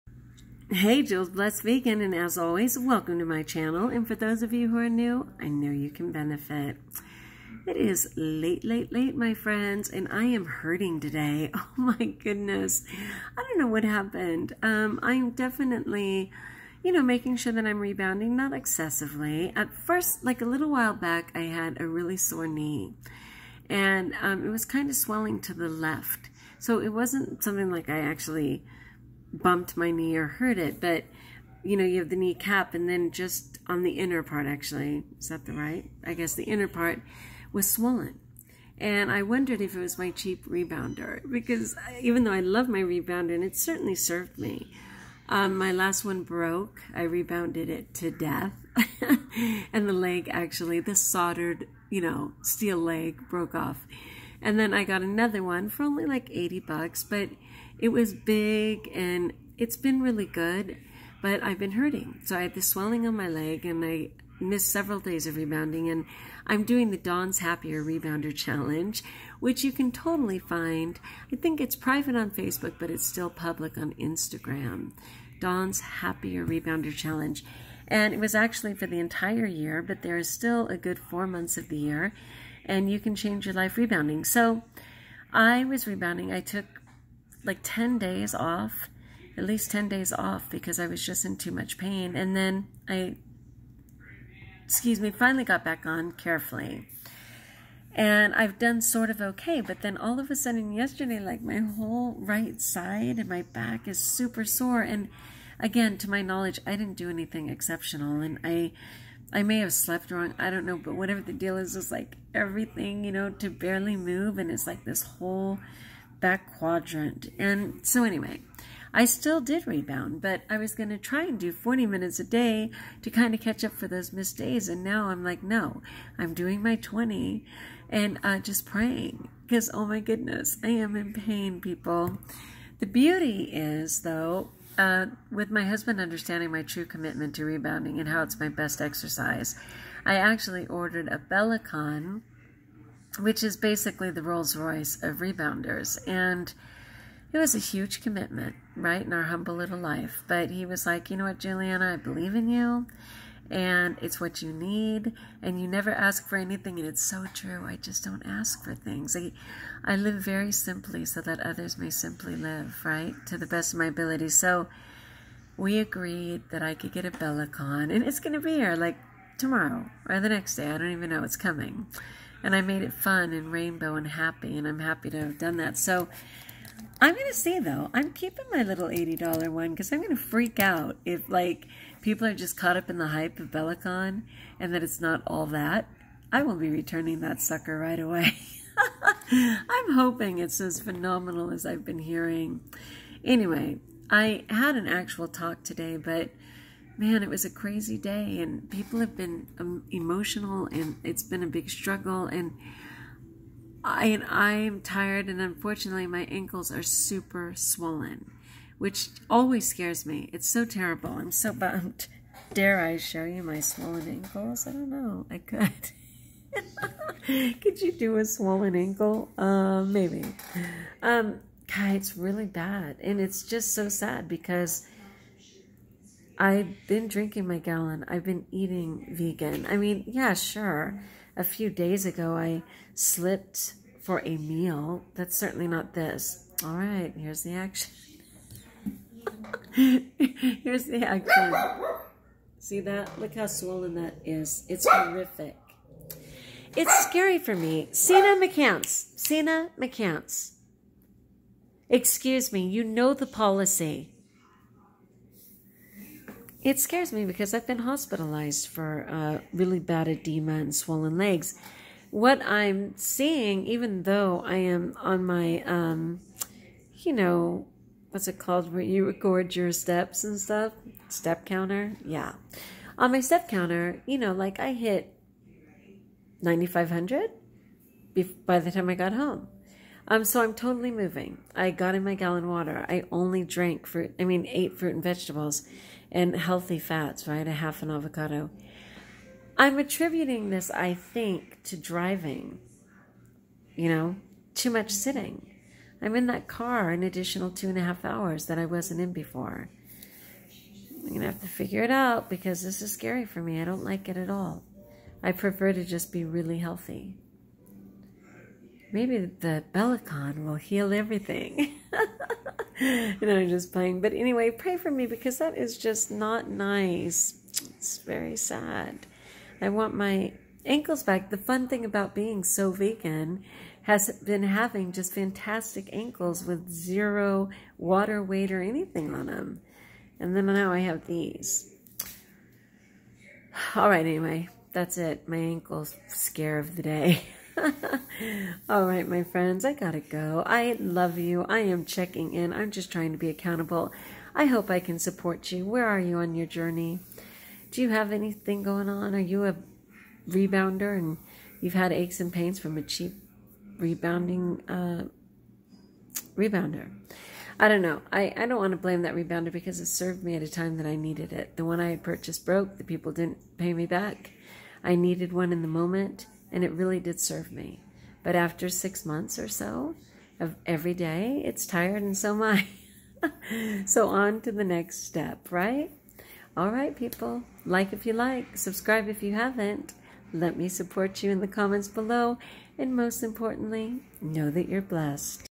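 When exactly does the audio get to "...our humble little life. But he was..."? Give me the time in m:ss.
2:29.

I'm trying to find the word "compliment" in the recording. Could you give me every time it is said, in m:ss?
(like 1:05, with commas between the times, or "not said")
not said.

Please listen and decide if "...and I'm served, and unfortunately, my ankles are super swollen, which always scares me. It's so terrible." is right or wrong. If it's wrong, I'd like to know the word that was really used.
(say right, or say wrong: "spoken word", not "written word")
wrong: "tired", not "served".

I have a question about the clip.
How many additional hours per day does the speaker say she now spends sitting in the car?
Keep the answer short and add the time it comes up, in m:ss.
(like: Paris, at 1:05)
2.5, at 4:57.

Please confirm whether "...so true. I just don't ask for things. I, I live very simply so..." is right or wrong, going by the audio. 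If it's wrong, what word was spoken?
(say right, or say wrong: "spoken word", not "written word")
right.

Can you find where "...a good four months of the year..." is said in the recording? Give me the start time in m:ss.
1:20.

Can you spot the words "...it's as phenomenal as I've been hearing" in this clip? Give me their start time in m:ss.
3:10.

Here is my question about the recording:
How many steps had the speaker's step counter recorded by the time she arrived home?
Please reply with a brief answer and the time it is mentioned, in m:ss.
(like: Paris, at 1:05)
9,500, at 4:36.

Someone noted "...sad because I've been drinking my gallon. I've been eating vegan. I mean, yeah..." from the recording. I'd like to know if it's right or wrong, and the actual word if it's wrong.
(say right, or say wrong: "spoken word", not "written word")
right.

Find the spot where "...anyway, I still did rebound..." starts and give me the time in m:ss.
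1:58.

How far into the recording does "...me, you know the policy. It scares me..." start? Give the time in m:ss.
4:12.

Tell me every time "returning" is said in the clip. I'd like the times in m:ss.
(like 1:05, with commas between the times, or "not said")
3:06.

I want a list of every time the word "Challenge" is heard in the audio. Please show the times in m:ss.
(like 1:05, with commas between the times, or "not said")
1:08, 1:16.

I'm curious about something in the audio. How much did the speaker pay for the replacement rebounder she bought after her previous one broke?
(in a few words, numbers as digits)
$80.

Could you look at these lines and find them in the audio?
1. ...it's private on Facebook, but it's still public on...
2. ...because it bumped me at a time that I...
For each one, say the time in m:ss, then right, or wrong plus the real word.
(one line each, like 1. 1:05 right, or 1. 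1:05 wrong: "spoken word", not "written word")
1. 1:11 right
2. 5:59 wrong: "served", not "bumped".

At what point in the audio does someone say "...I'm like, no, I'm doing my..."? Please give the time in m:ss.
2:05.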